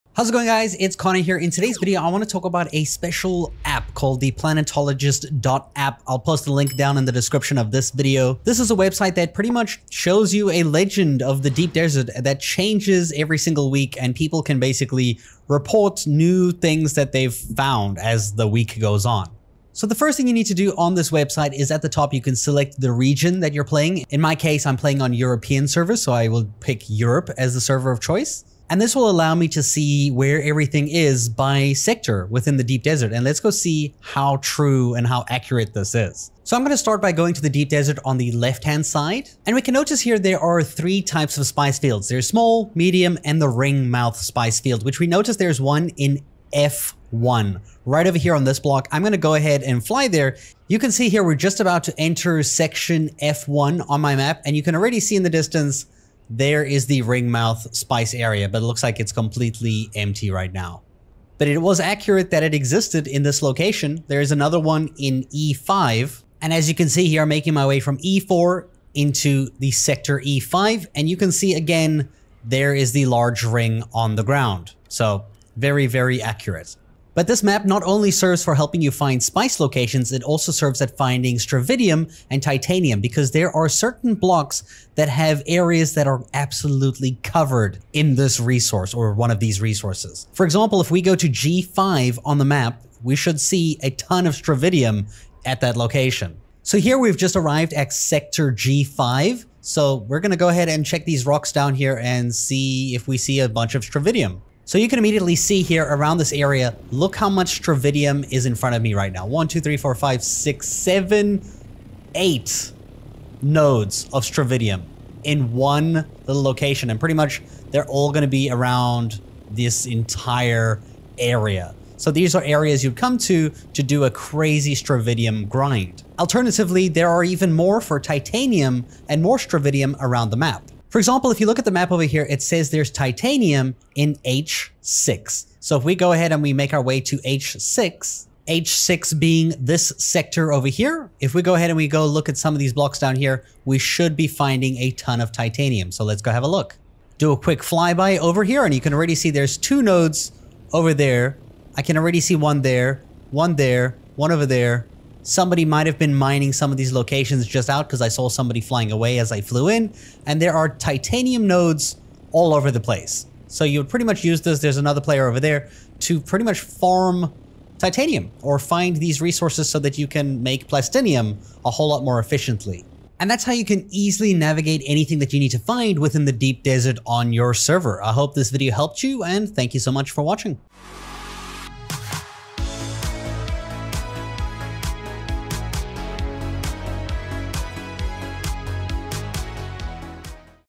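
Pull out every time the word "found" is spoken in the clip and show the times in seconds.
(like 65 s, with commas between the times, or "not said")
17 s.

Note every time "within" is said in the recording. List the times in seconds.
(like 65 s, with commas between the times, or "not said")
32 s, 175 s.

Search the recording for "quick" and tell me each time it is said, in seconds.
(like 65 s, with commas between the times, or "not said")
147 s.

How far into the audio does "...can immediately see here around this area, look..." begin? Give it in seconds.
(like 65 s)
104 s.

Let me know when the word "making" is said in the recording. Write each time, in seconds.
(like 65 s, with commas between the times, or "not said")
67 s.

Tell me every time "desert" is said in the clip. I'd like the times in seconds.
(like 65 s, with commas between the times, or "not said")
11 s, 32 s, 37 s, 176 s.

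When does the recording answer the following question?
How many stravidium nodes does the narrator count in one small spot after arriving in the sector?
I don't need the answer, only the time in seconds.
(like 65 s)
112 s.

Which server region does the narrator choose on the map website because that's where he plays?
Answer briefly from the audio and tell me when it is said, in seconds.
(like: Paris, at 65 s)
Europe, at 26 s.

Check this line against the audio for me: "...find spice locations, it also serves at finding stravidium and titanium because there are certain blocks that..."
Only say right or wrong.
right.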